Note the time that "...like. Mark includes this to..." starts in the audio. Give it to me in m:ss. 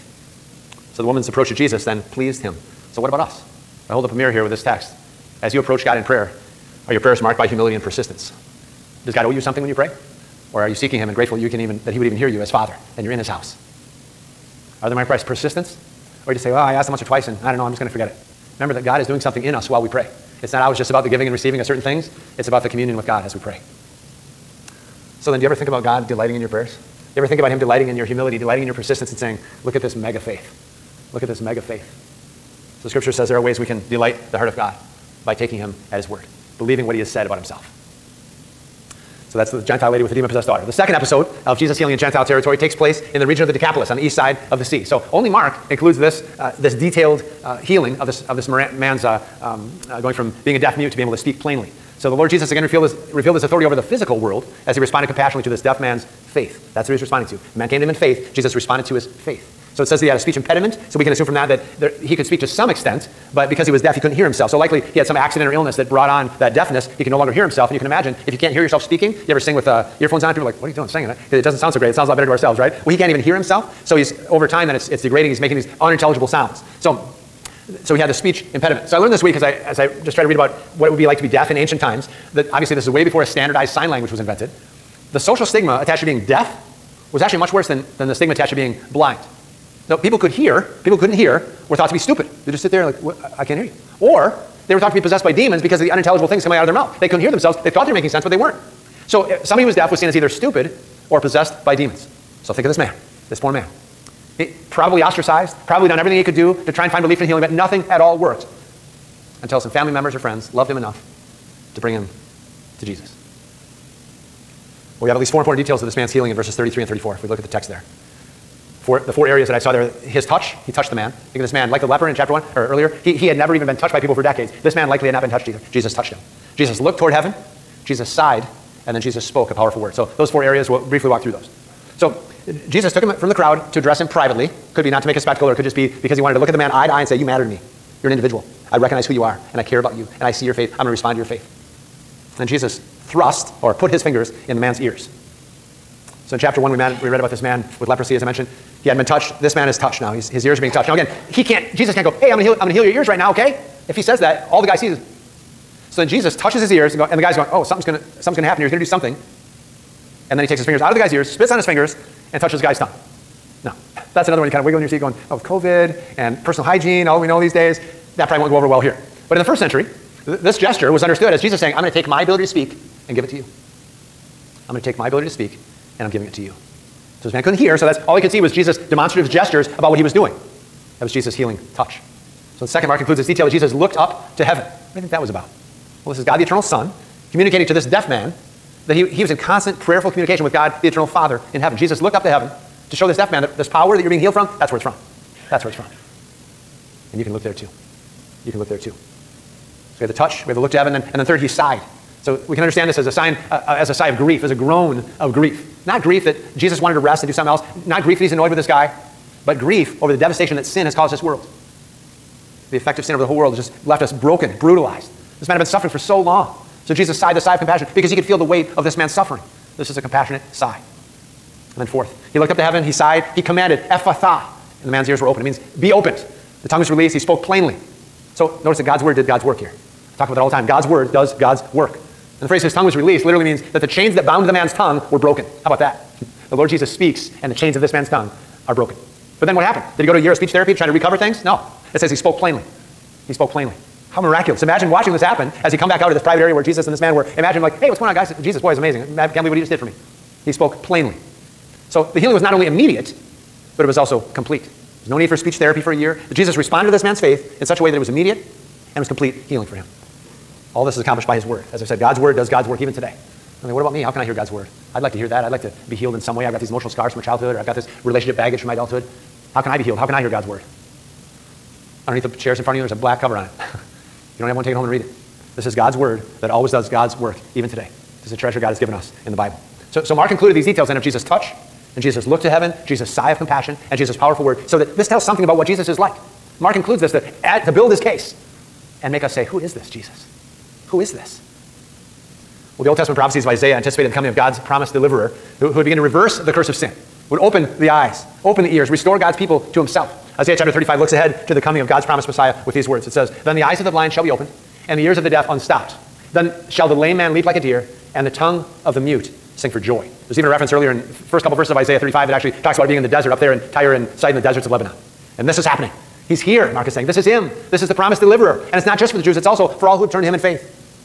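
4:45.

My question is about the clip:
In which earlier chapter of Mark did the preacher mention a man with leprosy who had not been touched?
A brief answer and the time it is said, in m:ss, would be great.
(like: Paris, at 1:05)
Chapter 1, at 2:26.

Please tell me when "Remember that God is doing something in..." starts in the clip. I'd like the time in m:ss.
0:18.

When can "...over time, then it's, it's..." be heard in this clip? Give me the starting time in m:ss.
1:14.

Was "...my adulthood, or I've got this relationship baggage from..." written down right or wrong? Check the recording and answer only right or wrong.
wrong.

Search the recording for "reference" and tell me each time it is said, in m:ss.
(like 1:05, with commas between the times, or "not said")
5:10.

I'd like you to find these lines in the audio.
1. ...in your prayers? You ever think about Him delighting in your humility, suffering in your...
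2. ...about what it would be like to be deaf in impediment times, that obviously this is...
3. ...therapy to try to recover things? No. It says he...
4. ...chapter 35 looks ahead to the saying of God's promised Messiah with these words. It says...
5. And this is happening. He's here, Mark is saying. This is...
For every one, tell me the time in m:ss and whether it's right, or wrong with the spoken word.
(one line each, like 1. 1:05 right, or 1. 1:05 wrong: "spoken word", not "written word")
1. 0:26 wrong: "delighting", not "suffering"
2. 1:20 wrong: "ancient", not "impediment"
3. 4:00 right
4. 5:00 wrong: "coming", not "saying"
5. 5:15 right.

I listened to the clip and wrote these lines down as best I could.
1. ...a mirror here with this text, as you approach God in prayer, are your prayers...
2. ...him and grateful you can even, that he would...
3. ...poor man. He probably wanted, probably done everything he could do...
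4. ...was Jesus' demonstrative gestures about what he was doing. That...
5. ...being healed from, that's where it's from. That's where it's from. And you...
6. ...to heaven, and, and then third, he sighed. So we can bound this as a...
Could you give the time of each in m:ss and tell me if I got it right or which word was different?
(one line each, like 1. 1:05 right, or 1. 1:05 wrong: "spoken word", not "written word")
1. 0:04 right
2. 0:10 right
3. 1:43 wrong: "ostracized", not "wanted"
4. 2:58 right
5. 3:14 right
6. 3:20 wrong: "understand", not "bound".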